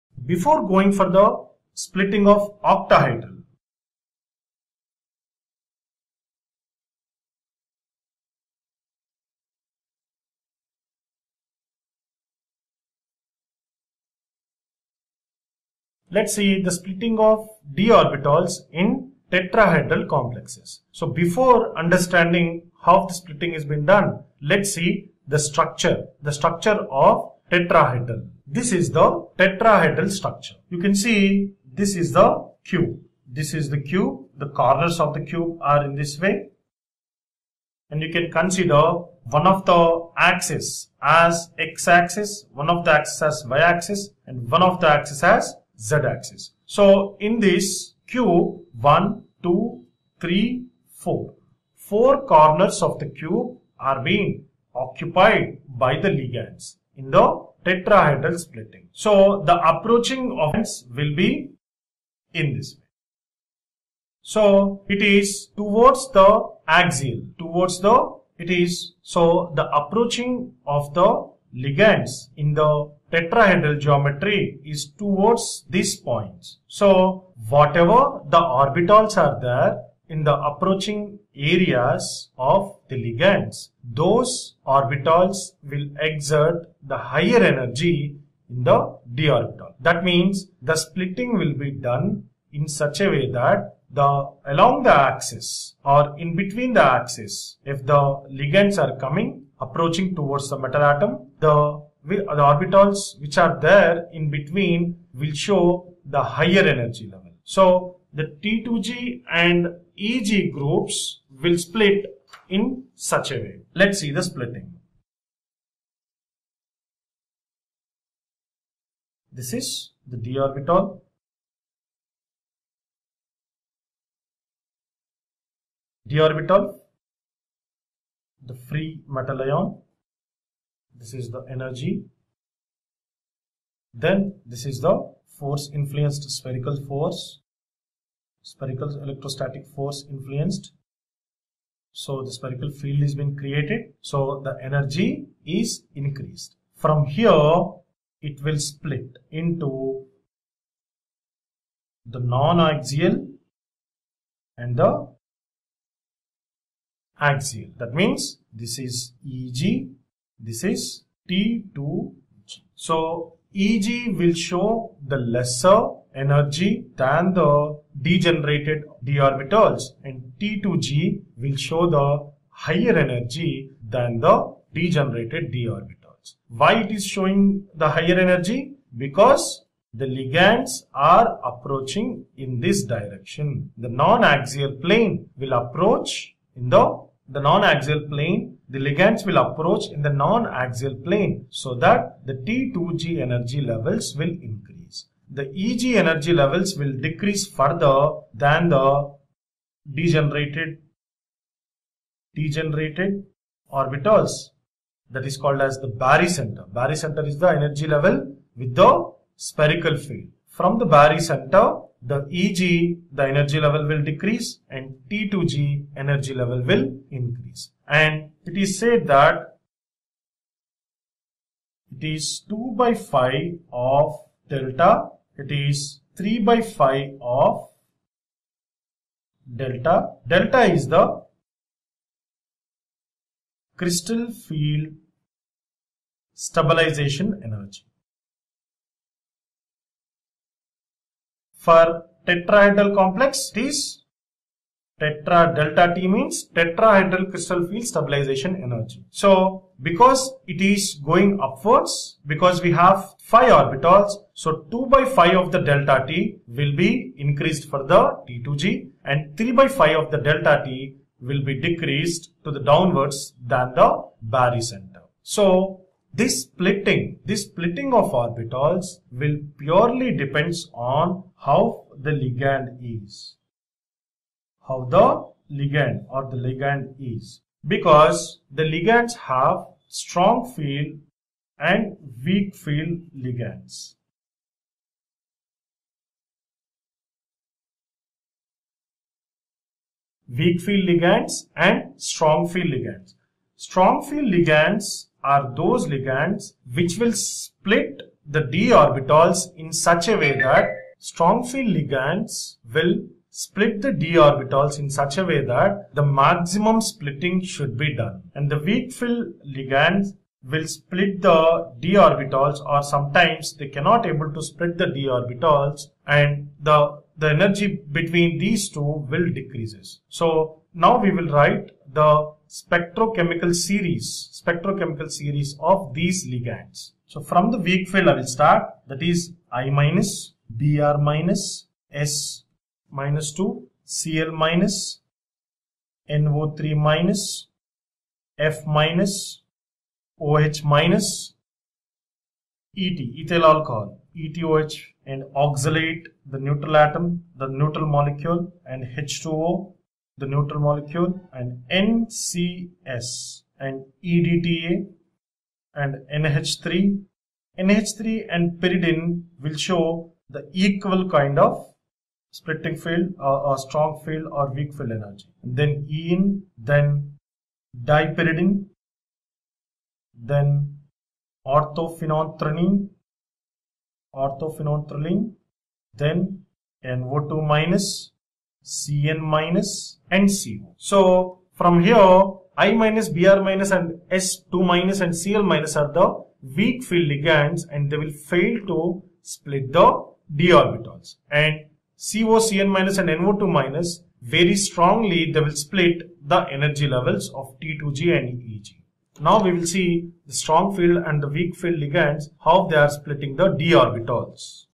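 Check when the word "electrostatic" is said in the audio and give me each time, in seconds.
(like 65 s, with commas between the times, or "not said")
139 s.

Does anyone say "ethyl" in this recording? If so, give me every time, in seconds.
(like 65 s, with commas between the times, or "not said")
343 s.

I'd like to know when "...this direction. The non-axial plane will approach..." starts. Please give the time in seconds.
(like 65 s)
182 s.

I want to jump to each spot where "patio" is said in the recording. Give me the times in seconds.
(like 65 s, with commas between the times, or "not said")
not said.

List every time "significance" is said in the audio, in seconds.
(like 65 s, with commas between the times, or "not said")
not said.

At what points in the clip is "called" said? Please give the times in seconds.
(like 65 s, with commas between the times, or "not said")
205 s.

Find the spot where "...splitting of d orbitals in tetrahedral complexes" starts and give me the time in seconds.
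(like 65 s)
16 s.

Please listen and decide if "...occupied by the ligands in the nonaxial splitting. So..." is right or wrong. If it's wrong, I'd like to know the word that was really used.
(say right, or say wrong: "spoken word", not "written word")
wrong: "tetrahedral", not "nonaxial".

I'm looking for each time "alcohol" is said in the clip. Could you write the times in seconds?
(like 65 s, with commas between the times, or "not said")
343 s.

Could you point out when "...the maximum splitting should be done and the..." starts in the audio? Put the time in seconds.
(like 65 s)
305 s.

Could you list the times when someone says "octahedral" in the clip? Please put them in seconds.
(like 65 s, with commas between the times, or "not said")
2 s.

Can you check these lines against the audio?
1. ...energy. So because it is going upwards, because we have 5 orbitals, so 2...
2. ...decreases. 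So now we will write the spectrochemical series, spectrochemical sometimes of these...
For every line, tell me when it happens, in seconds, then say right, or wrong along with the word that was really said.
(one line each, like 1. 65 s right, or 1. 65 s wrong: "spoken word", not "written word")
1. 248 s right
2. 319 s wrong: "series", not "sometimes".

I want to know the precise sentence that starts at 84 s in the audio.
Those orbitals will exert the higher energy in the d orbital.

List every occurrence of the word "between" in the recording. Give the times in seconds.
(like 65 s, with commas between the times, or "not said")
96 s, 104 s, 317 s.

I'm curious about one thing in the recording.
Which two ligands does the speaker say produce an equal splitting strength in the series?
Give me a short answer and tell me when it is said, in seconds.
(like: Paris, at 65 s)
NH3 and pyridine, at 357 s.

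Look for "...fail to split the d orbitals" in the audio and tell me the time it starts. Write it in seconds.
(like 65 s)
388 s.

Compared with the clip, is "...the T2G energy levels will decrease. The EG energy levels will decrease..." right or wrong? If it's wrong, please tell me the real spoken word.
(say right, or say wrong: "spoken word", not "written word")
wrong: "increase", not "decrease".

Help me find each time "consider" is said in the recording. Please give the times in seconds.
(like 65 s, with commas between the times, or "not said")
38 s.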